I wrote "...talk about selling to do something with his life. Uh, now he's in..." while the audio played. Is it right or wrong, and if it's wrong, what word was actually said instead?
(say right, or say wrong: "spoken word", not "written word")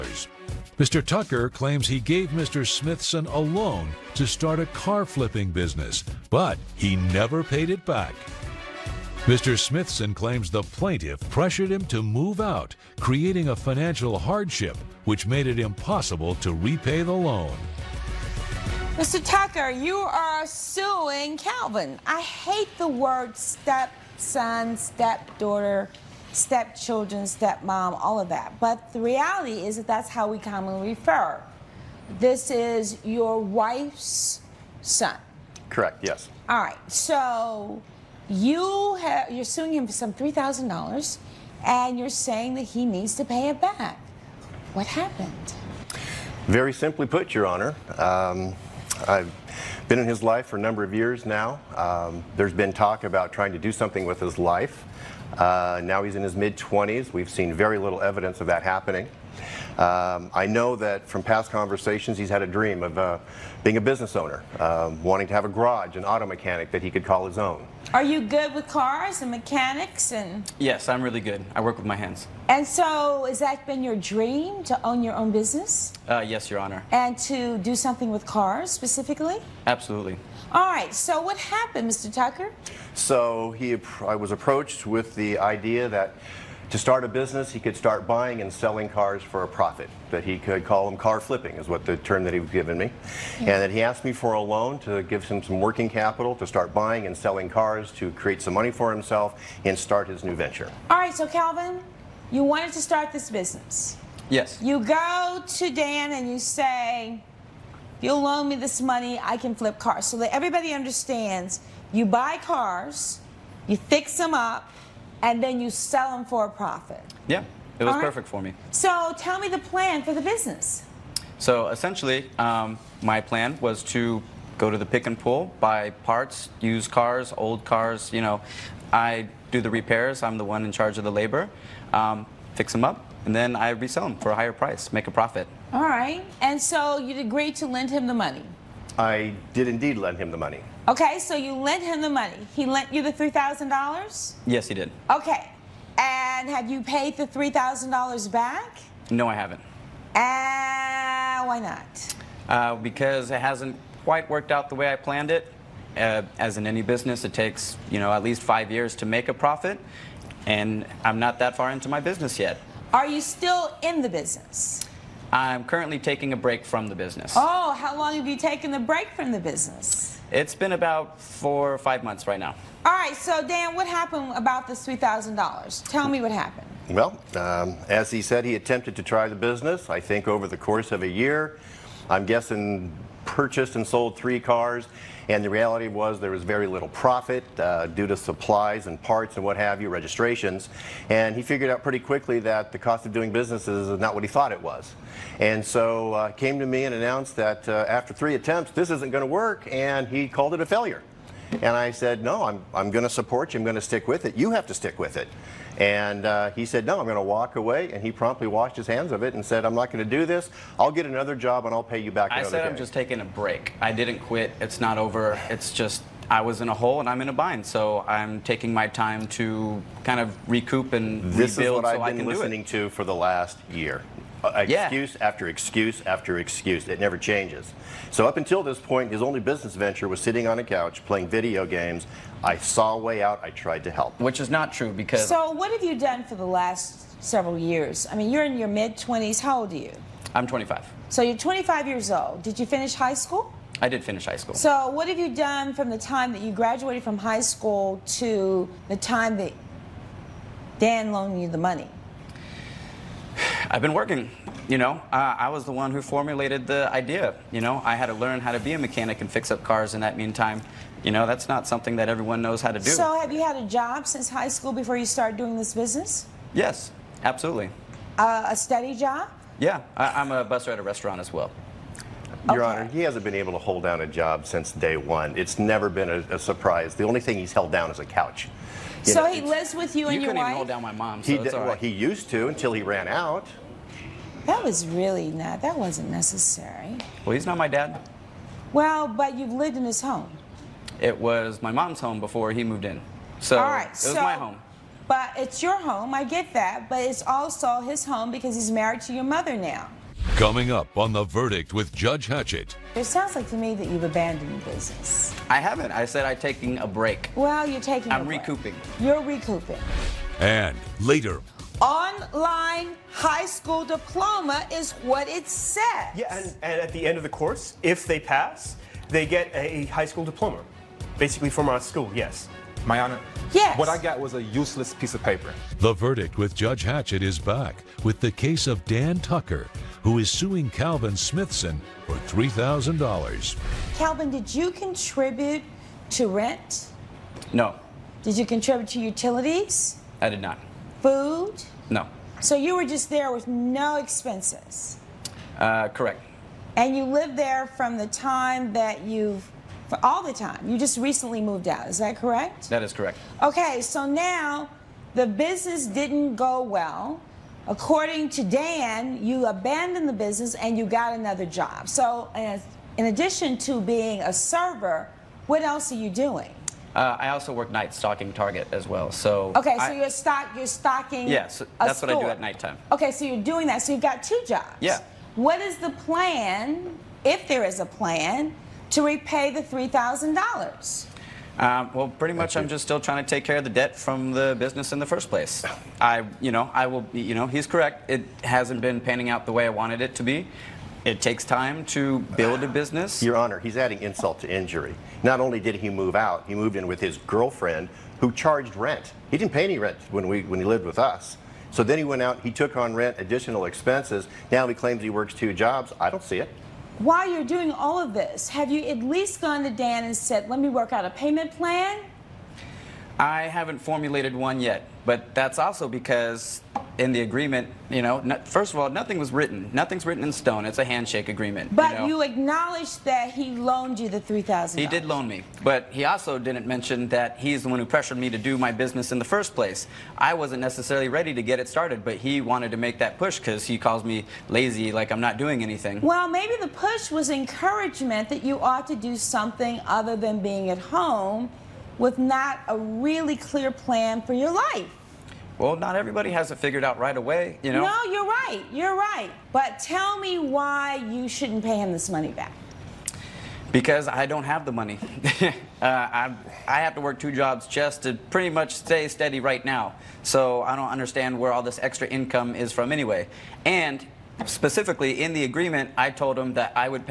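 wrong: "trying", not "selling".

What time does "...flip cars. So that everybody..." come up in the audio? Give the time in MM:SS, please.
01:49.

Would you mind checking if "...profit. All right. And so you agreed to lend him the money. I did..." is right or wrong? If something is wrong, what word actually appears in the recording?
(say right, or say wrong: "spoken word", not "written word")
right.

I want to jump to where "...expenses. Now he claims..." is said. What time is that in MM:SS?
06:43.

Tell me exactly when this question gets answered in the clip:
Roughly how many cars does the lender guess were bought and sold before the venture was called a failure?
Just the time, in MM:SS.
03:04.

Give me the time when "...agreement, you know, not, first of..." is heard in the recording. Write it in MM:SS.
06:57.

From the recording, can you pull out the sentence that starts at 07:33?
Because I don't have the money.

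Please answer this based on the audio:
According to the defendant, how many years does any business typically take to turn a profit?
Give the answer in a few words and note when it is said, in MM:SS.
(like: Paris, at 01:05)
5 years, at 02:38.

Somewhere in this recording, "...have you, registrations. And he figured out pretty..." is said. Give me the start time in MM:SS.
03:09.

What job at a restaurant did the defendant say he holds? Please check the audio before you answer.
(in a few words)
busser.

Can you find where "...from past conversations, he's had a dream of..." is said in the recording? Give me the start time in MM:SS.
01:01.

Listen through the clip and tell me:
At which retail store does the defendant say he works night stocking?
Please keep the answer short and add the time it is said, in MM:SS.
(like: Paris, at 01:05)
Target, at 06:08.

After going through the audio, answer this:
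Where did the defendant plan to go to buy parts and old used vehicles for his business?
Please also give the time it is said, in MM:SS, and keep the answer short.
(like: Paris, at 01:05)
the pick and pull, at 02:04.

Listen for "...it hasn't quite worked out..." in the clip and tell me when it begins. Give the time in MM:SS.
02:33.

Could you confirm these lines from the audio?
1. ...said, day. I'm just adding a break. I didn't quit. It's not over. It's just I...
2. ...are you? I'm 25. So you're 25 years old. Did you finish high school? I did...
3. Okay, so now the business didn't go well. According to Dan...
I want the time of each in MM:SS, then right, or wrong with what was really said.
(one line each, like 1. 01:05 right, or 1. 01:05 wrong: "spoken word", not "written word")
1. 03:32 wrong: "taking", not "adding"
2. 03:59 right
3. 05:53 right.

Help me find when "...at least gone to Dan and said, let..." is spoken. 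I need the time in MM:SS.
06:48.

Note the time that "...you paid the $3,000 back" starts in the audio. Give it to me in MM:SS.
02:26.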